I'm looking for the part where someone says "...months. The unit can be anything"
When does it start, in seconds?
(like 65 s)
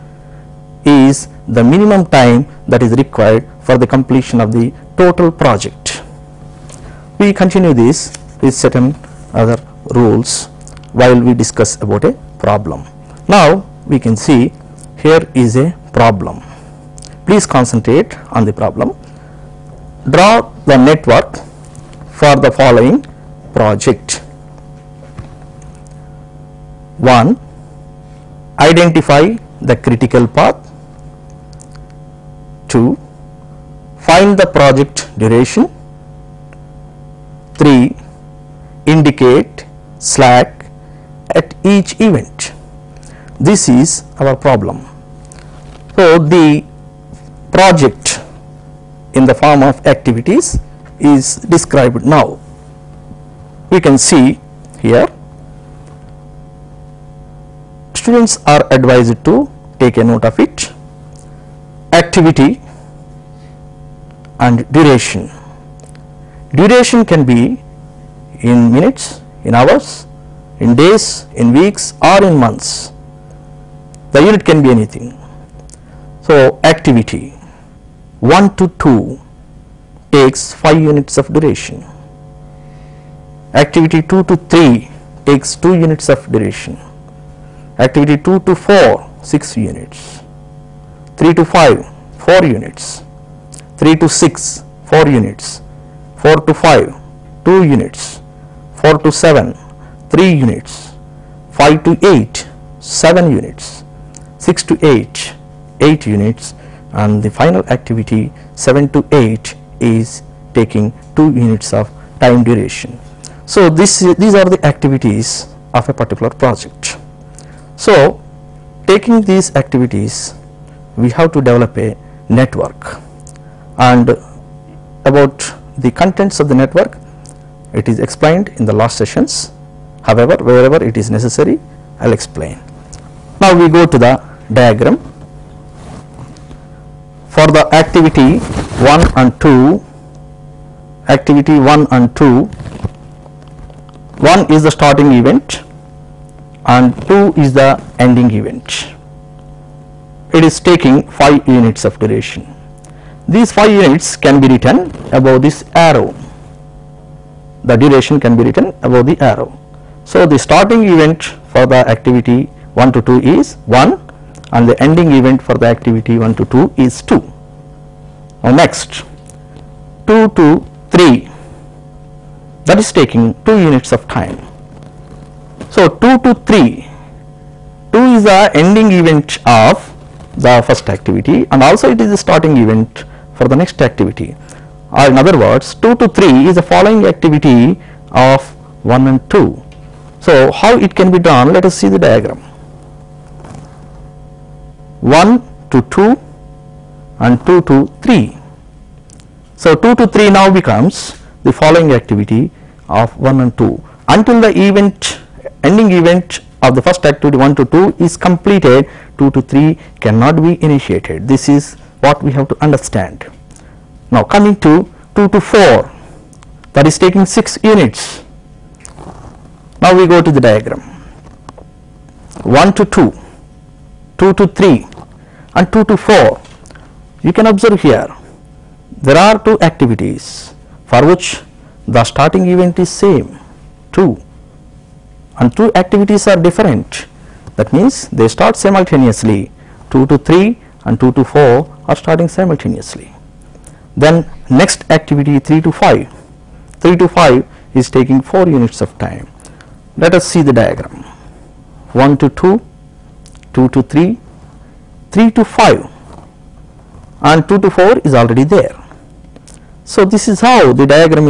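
72 s.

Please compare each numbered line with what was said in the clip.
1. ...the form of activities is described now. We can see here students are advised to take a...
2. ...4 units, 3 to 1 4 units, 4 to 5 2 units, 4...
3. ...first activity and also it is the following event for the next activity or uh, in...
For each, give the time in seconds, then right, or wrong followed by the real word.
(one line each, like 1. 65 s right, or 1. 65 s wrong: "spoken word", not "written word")
1. 49 s right
2. 92 s wrong: "6", not "1"
3. 180 s wrong: "starting", not "following".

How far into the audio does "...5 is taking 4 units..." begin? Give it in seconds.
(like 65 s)
247 s.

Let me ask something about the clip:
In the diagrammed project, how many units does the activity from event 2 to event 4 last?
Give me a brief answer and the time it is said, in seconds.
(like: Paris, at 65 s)
6 units, at 88 s.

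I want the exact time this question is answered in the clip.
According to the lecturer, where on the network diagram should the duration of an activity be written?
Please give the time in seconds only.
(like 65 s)
158 s.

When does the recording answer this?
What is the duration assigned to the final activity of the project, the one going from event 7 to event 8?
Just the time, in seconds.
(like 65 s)
108 s.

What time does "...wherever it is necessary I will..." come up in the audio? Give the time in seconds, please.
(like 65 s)
130 s.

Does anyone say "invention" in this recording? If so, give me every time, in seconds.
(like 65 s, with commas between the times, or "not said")
not said.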